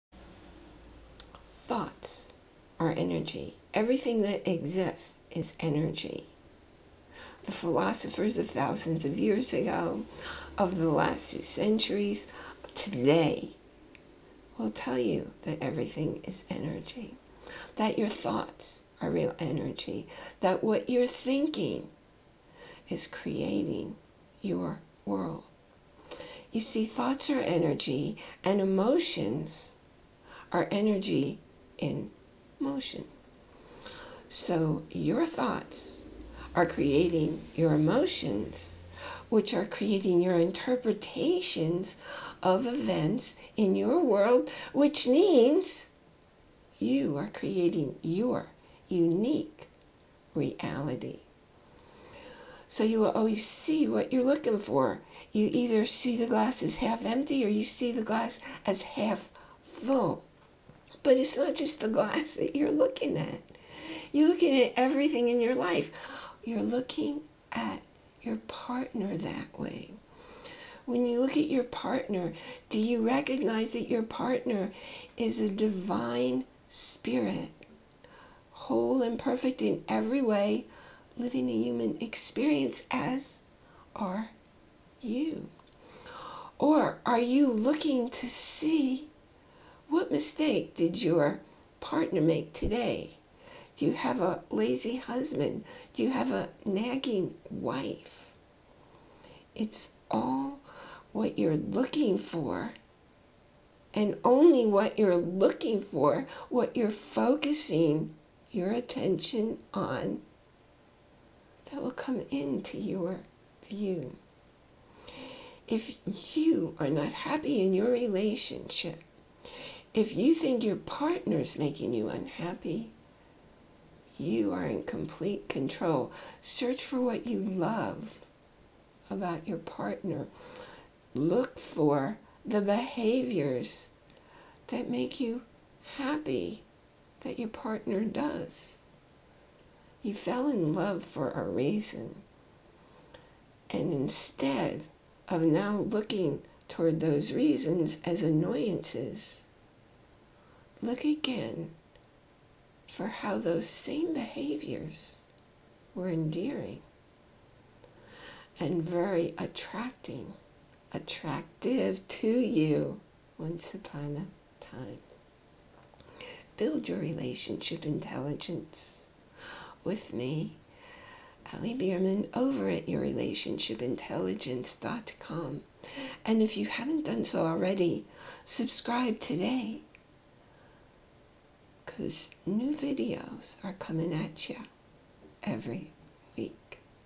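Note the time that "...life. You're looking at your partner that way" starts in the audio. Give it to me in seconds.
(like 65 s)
65 s.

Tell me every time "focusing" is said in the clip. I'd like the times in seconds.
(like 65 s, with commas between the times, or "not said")
106 s.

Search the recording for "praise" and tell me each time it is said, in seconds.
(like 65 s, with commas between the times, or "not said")
not said.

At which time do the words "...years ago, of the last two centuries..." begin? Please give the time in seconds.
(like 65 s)
9 s.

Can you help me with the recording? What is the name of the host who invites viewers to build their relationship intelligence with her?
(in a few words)
Ali Bierman.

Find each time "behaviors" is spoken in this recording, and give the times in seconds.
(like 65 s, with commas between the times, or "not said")
132 s, 154 s.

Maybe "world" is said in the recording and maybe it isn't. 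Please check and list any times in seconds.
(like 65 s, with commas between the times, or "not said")
25 s, 44 s.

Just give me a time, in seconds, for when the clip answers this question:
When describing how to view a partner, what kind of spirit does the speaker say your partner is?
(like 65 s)
75 s.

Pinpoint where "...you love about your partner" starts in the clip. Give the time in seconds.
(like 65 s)
127 s.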